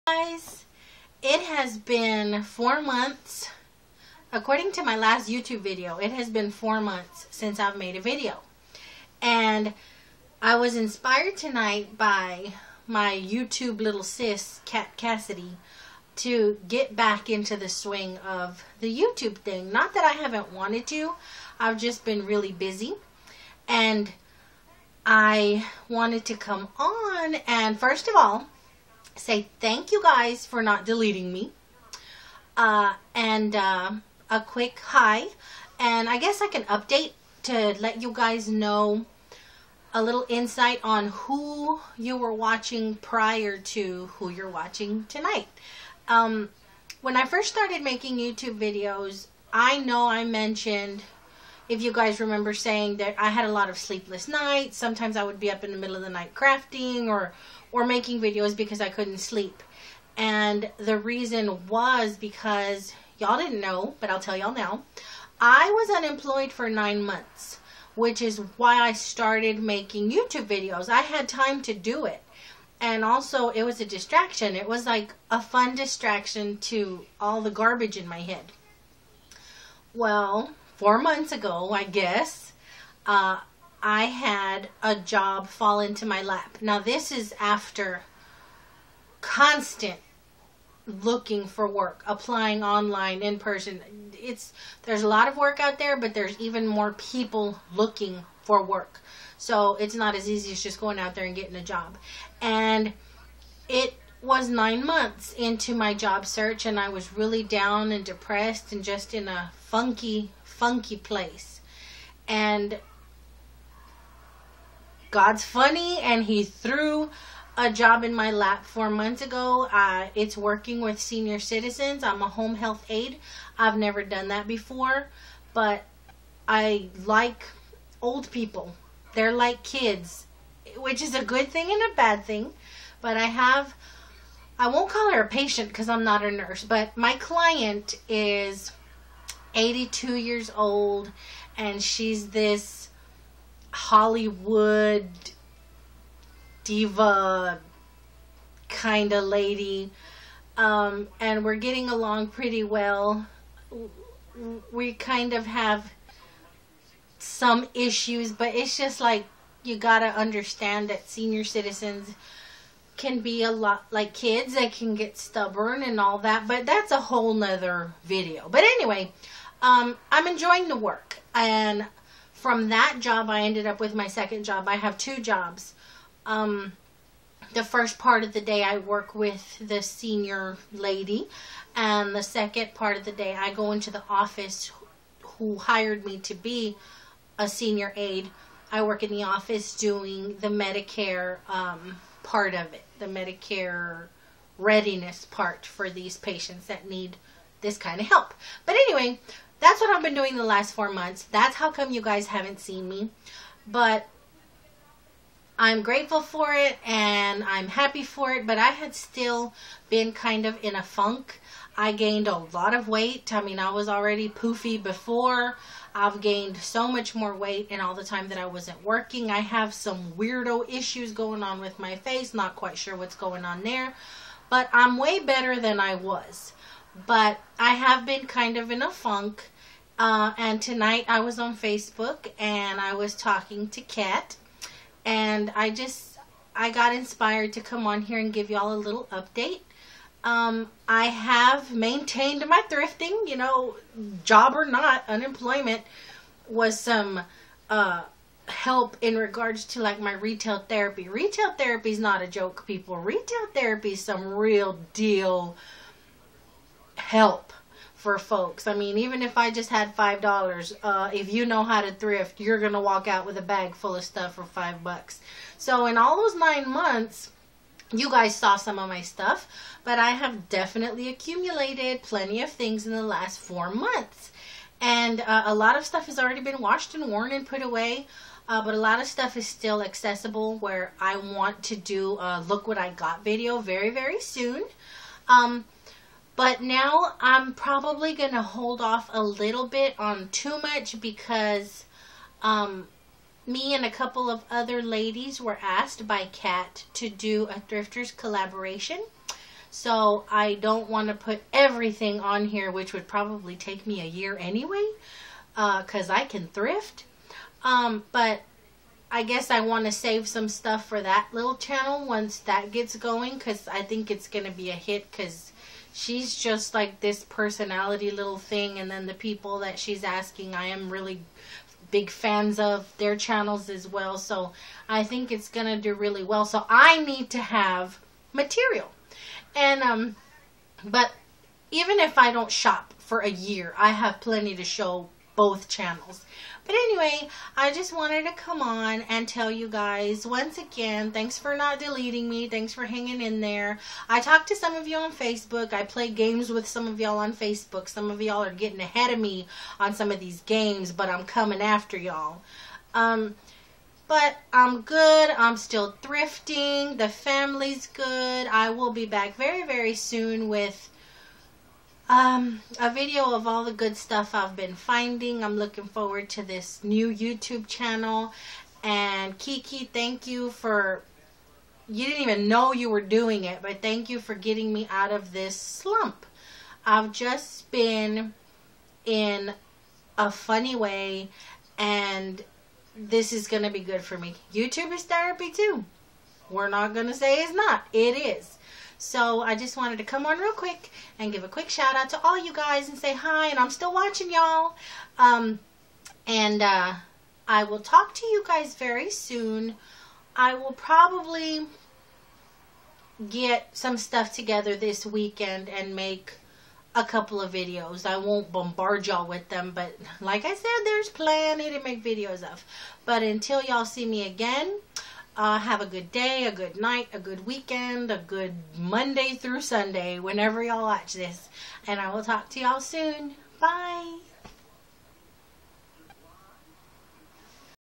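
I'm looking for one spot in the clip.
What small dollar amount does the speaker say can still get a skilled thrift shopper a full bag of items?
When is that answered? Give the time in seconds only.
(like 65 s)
259 s.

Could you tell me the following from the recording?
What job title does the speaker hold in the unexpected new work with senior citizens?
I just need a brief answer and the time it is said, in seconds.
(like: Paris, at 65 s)
Home health aide, at 122 s.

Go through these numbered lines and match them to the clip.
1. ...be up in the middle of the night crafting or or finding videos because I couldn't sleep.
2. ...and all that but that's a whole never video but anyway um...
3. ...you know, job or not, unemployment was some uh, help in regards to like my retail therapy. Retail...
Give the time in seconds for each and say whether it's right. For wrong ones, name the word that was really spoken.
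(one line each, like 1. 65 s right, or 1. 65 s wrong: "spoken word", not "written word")
1. 55 s wrong: "making", not "finding"
2. 165 s wrong: "nother", not "never"
3. 243 s right.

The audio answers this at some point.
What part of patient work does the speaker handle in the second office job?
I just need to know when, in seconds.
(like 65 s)
193 s.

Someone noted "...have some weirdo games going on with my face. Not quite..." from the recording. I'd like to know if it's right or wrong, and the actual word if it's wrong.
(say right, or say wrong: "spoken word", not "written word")
wrong: "issues", not "games".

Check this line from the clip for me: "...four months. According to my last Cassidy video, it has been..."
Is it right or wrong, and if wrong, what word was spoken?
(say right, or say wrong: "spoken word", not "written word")
wrong: "YouTube", not "Cassidy".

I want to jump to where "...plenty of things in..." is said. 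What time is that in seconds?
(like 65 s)
272 s.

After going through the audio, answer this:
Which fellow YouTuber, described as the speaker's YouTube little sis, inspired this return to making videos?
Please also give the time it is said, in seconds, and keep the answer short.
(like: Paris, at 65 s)
Cat Cassidy, at 14 s.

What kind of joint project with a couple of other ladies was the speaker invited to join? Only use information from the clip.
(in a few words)
Thrifters collaboration.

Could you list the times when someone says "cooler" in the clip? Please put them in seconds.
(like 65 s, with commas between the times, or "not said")
not said.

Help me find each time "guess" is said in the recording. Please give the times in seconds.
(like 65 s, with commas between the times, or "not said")
36 s, 81 s, 309 s.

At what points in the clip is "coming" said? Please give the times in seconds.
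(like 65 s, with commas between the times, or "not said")
351 s.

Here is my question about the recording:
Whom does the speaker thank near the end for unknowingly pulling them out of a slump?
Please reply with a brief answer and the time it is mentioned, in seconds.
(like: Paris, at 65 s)
Kiki, at 369 s.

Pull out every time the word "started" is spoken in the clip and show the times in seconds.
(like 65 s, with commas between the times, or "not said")
47 s, 68 s.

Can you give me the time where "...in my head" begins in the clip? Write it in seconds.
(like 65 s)
77 s.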